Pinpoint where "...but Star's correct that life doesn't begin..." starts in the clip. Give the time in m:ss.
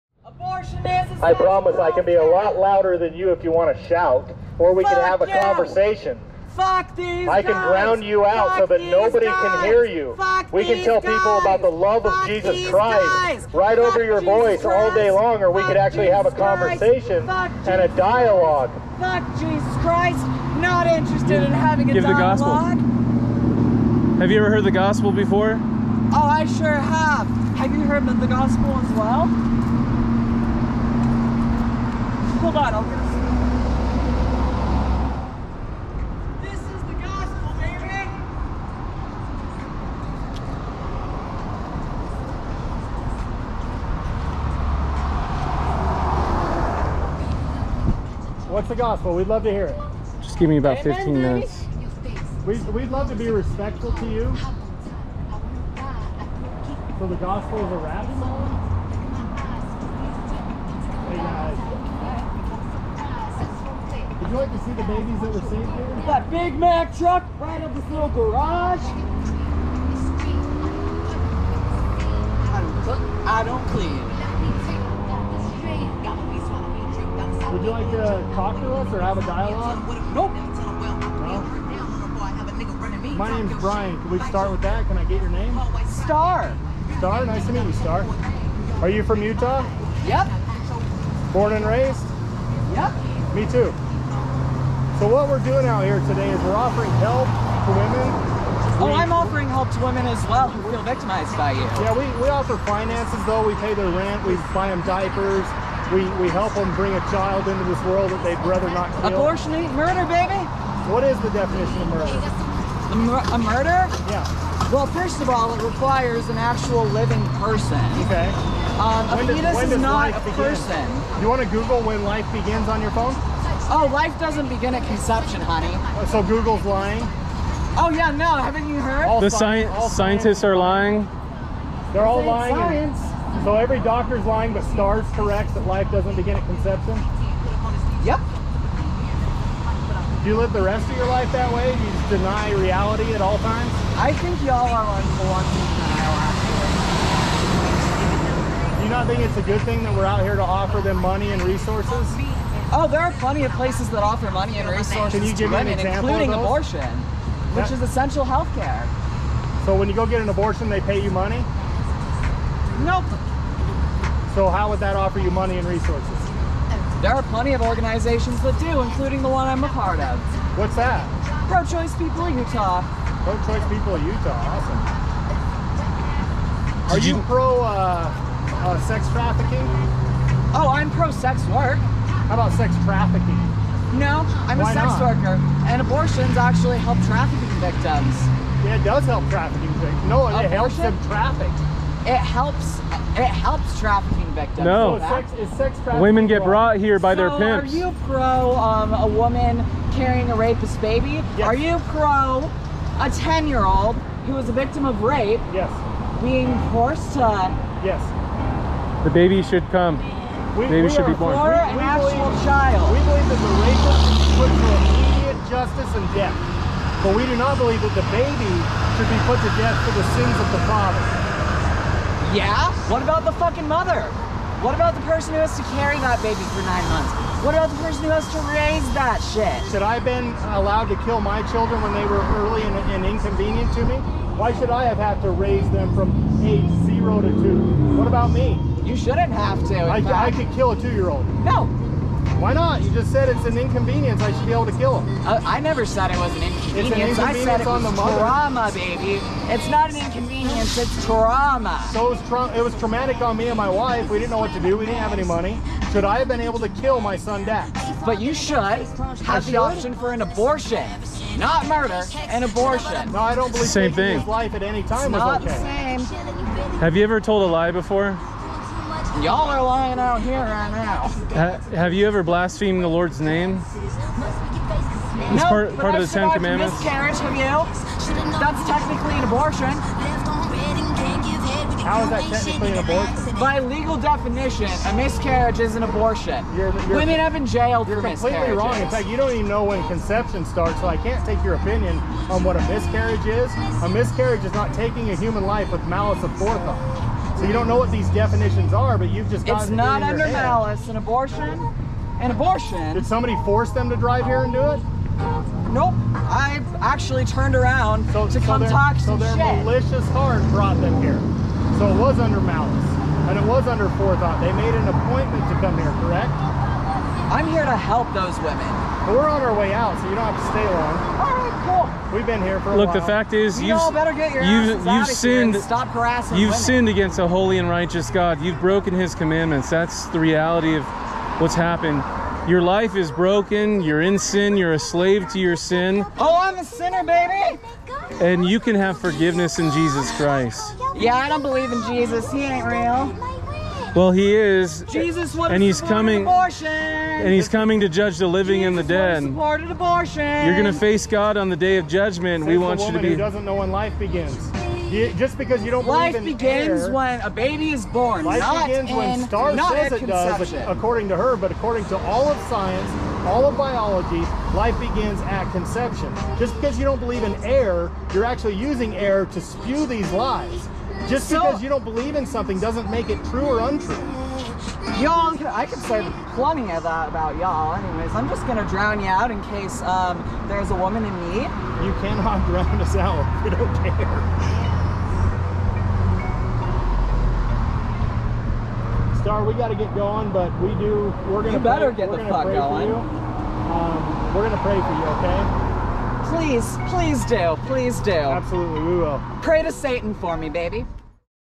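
2:14.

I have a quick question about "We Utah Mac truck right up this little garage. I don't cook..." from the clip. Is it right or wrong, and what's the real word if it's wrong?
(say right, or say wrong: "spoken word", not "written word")
wrong: "Big", not "Utah".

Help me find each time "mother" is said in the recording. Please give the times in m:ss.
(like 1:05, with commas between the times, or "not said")
3:43, 4:07.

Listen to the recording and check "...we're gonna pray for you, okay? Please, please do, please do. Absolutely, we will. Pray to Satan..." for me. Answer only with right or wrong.
right.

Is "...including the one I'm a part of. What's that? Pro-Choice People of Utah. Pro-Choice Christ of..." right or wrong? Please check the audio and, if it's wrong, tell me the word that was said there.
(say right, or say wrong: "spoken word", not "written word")
wrong: "People", not "Christ".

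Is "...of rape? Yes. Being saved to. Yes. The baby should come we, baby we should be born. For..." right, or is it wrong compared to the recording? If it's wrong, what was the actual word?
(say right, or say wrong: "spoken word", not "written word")
wrong: "forced", not "saved".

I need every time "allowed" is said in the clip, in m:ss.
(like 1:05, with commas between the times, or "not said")
3:50.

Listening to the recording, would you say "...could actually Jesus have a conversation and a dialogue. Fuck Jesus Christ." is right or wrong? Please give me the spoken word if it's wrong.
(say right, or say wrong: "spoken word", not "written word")
right.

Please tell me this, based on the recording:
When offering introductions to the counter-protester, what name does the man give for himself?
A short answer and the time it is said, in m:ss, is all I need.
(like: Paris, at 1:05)
Brian, at 1:23.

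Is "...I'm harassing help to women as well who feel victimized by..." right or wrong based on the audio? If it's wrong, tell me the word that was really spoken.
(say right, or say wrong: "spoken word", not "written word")
wrong: "offering", not "harassing".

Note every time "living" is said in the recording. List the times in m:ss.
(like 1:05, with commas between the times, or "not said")
1:56, 5:48.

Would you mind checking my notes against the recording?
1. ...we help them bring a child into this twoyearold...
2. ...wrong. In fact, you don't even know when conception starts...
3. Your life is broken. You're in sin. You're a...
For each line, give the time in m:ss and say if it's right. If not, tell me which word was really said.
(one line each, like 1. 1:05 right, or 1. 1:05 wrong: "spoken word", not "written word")
1. 1:46 wrong: "world", not "twoyearold"
2. 4:48 right
3. 5:32 right.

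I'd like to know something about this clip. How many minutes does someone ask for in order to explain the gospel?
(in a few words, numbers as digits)
15.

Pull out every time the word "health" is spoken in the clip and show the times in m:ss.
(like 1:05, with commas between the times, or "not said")
2:38.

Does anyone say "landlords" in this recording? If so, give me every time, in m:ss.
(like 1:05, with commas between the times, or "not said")
not said.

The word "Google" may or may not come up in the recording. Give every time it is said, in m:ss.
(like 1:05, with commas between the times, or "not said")
2:01, 2:06.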